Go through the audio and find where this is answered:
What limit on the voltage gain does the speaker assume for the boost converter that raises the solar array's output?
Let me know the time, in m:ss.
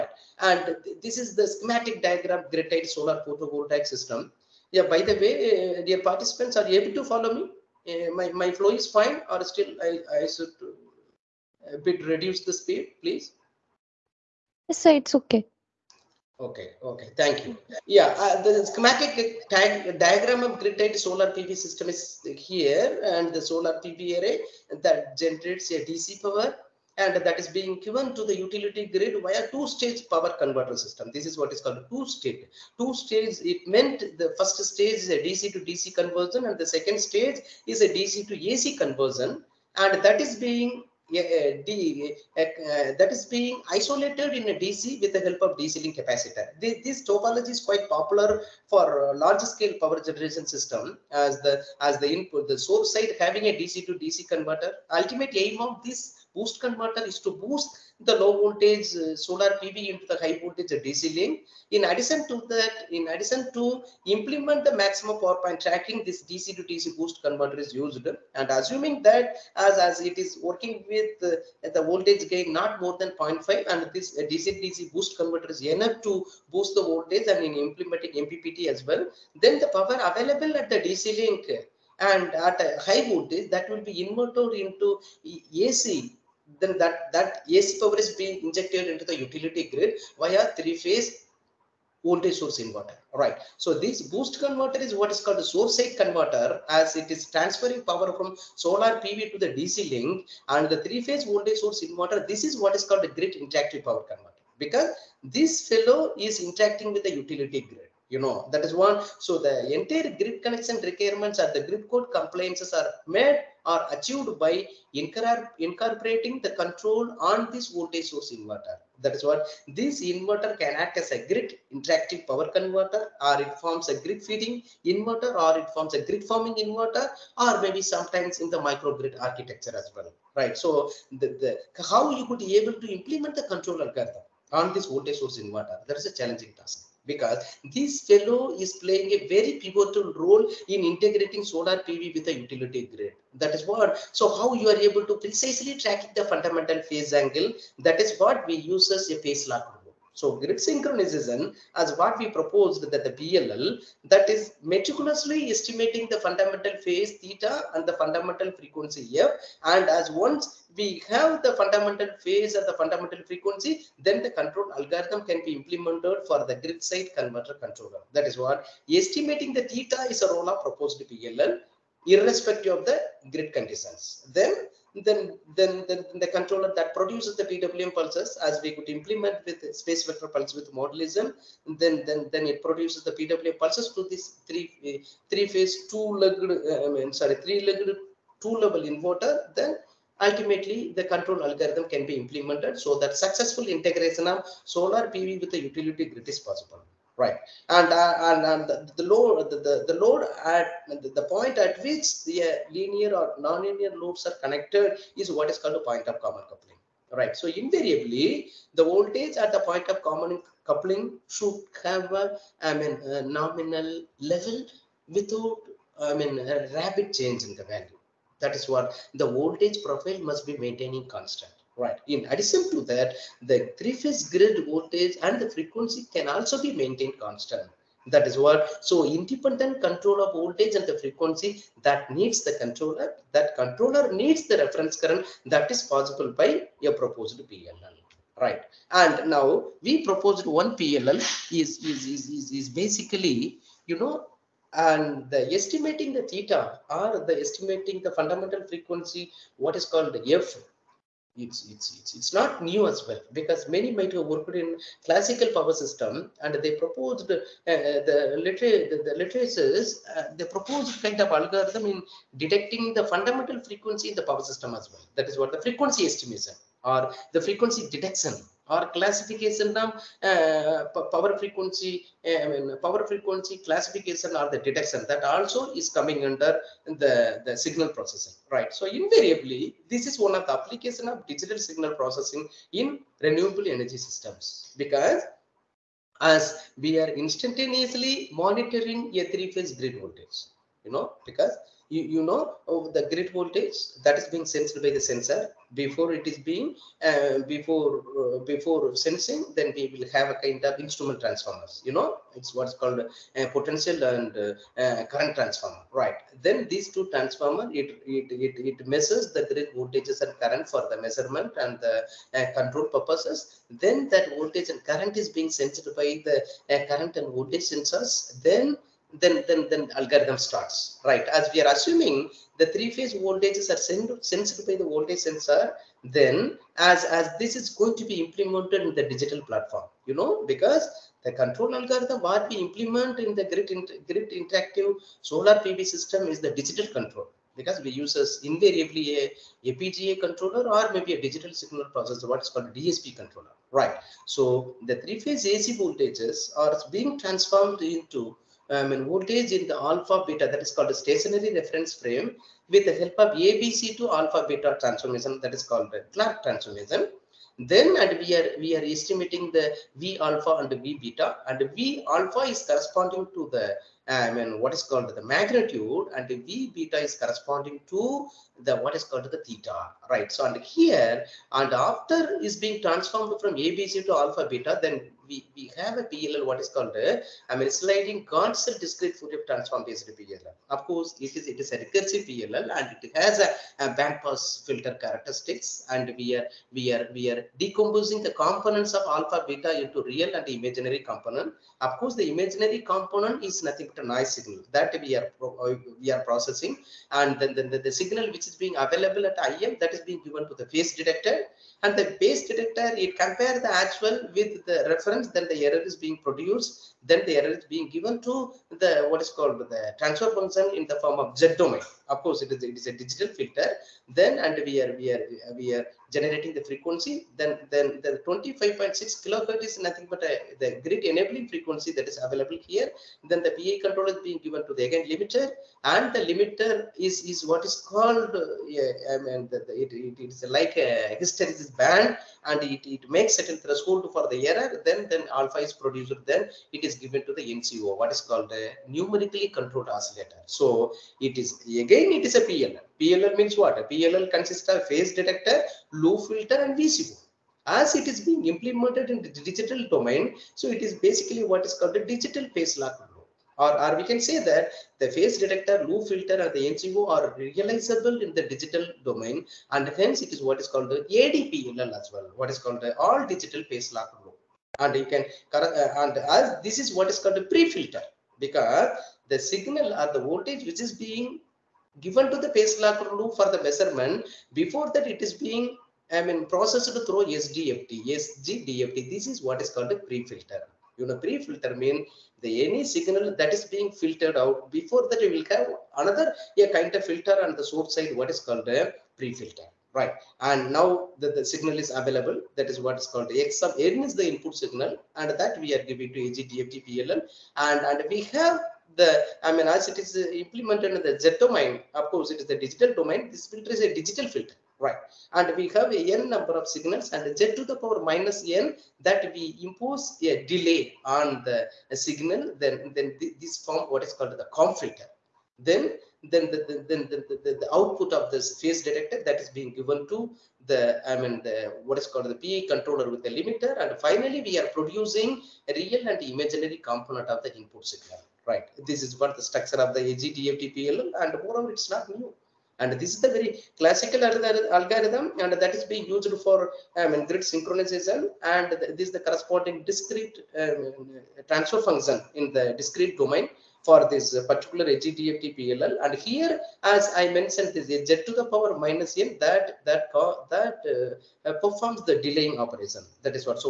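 1:13.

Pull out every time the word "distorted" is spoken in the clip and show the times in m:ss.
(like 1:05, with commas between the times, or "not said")
not said.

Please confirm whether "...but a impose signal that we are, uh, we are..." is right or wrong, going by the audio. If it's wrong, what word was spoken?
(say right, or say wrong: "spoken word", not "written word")
wrong: "noise", not "impose".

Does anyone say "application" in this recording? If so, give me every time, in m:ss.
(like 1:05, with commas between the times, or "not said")
4:40.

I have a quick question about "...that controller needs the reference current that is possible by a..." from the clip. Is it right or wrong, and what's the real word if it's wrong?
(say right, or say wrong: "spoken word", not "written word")
right.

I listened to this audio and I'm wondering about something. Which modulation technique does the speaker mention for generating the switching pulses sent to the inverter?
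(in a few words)
space vector pulse width modulation.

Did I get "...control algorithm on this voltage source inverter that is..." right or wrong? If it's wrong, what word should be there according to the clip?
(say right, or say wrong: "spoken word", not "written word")
right.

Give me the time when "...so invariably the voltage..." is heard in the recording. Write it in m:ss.
3:27.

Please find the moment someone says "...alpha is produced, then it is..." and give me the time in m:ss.
7:15.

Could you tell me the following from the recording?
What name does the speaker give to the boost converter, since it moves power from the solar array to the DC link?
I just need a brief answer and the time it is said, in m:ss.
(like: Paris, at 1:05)
source side converter, at 1:35.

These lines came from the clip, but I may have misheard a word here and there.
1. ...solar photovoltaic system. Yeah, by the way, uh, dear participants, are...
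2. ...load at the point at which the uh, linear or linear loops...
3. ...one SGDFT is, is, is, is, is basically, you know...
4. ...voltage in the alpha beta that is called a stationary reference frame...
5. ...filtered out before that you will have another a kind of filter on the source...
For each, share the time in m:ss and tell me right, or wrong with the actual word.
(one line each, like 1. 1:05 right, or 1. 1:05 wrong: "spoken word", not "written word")
1. 0:02 right
2. 3:19 wrong: "nonlinear", not "linear"
3. 4:00 wrong: "PLL", not "SGDFT"
4. 5:49 right
5. 8:04 right.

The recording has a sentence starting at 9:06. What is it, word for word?
And here, as I mentioned, this is z to the power minus n that that that uh, uh, performs the delaying operation.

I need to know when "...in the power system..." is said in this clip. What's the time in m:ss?
4:24.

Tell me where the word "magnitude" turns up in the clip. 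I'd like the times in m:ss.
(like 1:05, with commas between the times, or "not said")
6:05.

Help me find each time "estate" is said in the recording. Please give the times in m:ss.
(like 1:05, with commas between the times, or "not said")
not said.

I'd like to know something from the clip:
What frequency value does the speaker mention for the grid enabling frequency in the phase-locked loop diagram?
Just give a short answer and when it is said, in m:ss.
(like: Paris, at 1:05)
25.6 kilohertz, at 6:58.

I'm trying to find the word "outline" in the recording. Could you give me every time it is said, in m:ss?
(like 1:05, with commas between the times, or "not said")
not said.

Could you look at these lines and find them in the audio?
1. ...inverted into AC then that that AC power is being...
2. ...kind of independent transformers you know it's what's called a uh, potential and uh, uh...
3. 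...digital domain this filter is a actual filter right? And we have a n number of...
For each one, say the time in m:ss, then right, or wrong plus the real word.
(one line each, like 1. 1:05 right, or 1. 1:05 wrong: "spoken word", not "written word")
1. 1:24 right
2. 5:00 wrong: "instrument", not "independent"
3. 8:22 wrong: "digital", not "actual".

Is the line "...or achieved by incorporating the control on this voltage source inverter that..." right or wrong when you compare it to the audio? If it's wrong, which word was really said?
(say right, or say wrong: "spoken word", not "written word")
right.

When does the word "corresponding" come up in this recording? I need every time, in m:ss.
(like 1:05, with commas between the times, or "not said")
6:02, 6:07, 8:59.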